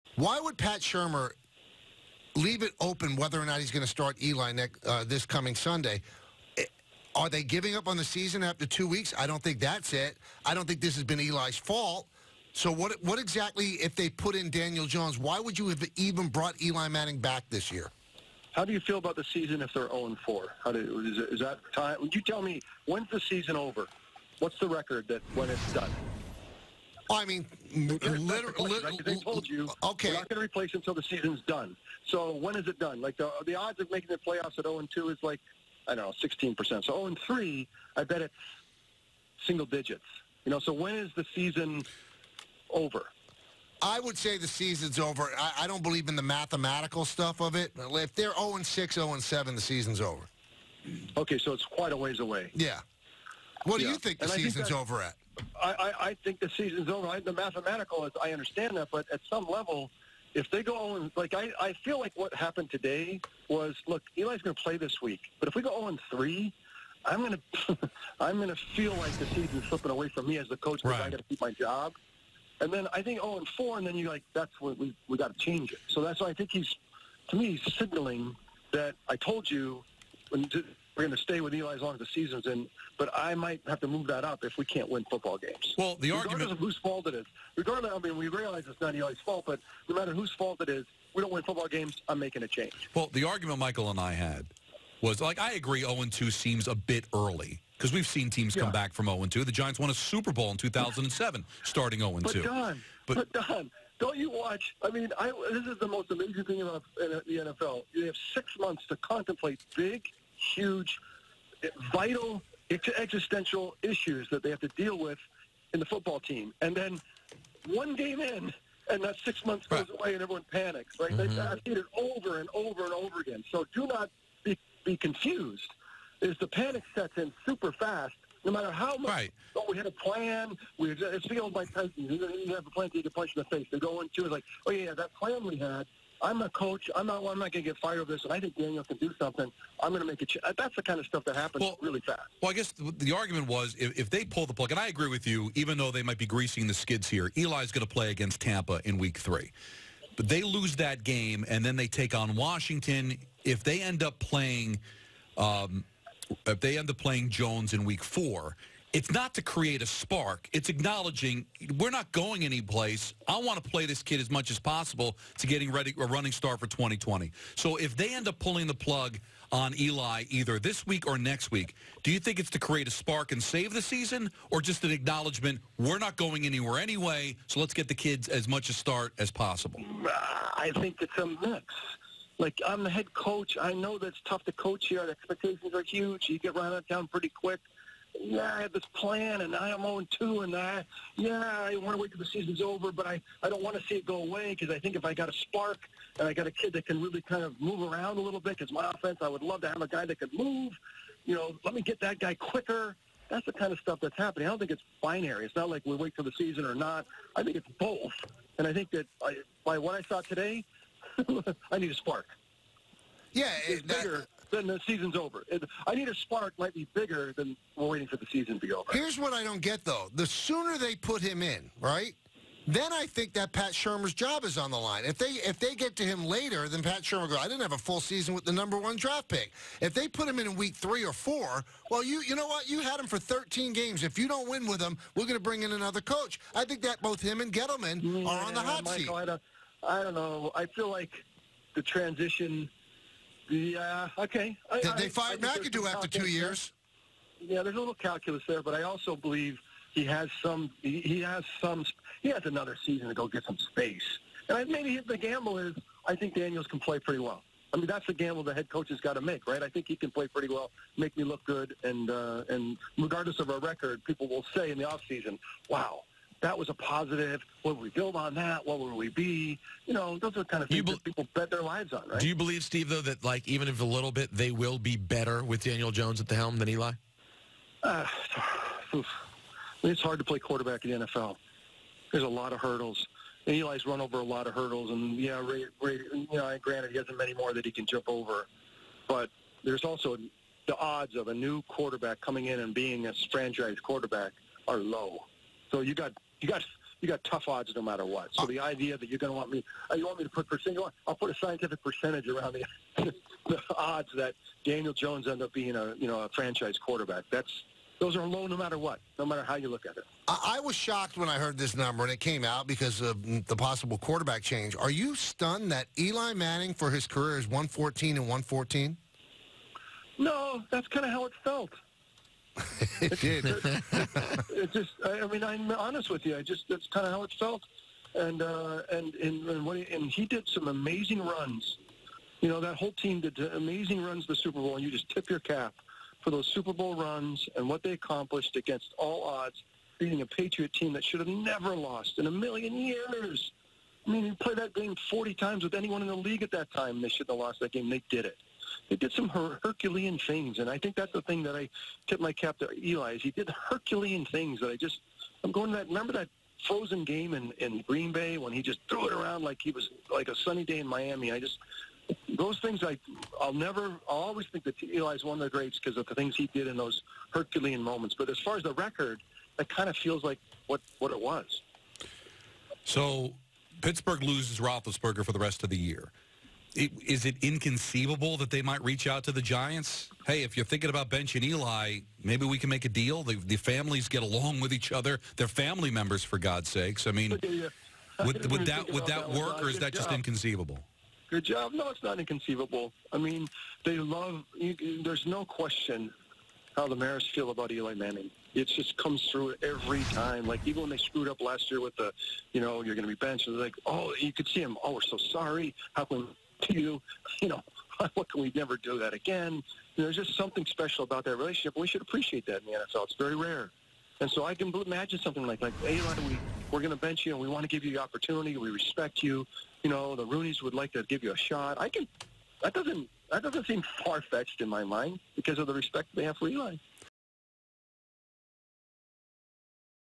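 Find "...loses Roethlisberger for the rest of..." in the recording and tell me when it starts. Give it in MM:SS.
06:14.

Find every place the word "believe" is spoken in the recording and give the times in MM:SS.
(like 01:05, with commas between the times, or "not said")
00:45, 04:09, 04:32.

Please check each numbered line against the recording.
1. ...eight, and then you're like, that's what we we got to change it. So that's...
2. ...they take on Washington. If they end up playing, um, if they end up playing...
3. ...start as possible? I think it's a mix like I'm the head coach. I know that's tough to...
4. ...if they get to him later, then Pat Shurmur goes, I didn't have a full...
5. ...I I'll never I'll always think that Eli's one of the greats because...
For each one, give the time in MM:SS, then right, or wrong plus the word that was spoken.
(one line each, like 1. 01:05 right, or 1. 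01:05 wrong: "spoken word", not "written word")
1. 01:13 wrong: "four", not "eight"
2. 02:31 right
3. 02:58 right
4. 03:45 right
5. 06:02 right.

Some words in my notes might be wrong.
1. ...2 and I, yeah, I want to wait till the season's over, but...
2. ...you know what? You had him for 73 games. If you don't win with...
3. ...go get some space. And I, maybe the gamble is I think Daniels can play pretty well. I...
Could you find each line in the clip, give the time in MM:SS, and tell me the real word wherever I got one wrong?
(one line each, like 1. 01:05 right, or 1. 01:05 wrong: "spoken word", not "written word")
1. 03:10 right
2. 03:52 wrong: "13", not "73"
3. 04:13 right.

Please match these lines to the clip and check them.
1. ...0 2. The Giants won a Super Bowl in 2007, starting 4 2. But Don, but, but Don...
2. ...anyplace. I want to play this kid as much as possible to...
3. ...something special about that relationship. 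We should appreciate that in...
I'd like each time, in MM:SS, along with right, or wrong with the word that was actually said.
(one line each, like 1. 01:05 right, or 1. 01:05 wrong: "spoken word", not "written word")
1. 01:39 wrong: "0", not "4"
2. 02:42 right
3. 06:50 right.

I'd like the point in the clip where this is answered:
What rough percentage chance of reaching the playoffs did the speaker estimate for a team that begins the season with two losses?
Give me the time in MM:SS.
00:36.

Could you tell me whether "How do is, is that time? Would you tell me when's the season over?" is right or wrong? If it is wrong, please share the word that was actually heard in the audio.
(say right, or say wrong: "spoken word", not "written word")
right.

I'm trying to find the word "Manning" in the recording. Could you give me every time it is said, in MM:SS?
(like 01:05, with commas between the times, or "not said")
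00:16, 05:16, 06:37.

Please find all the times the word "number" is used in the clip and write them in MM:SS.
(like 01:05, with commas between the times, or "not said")
03:48, 05:11.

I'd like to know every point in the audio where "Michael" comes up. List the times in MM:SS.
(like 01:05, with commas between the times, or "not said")
01:33, 03:58.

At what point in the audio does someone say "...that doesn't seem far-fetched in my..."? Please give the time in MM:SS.
07:03.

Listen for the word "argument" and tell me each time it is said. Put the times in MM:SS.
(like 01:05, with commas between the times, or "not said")
01:26, 01:33, 02:23.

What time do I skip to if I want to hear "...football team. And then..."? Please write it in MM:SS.
01:55.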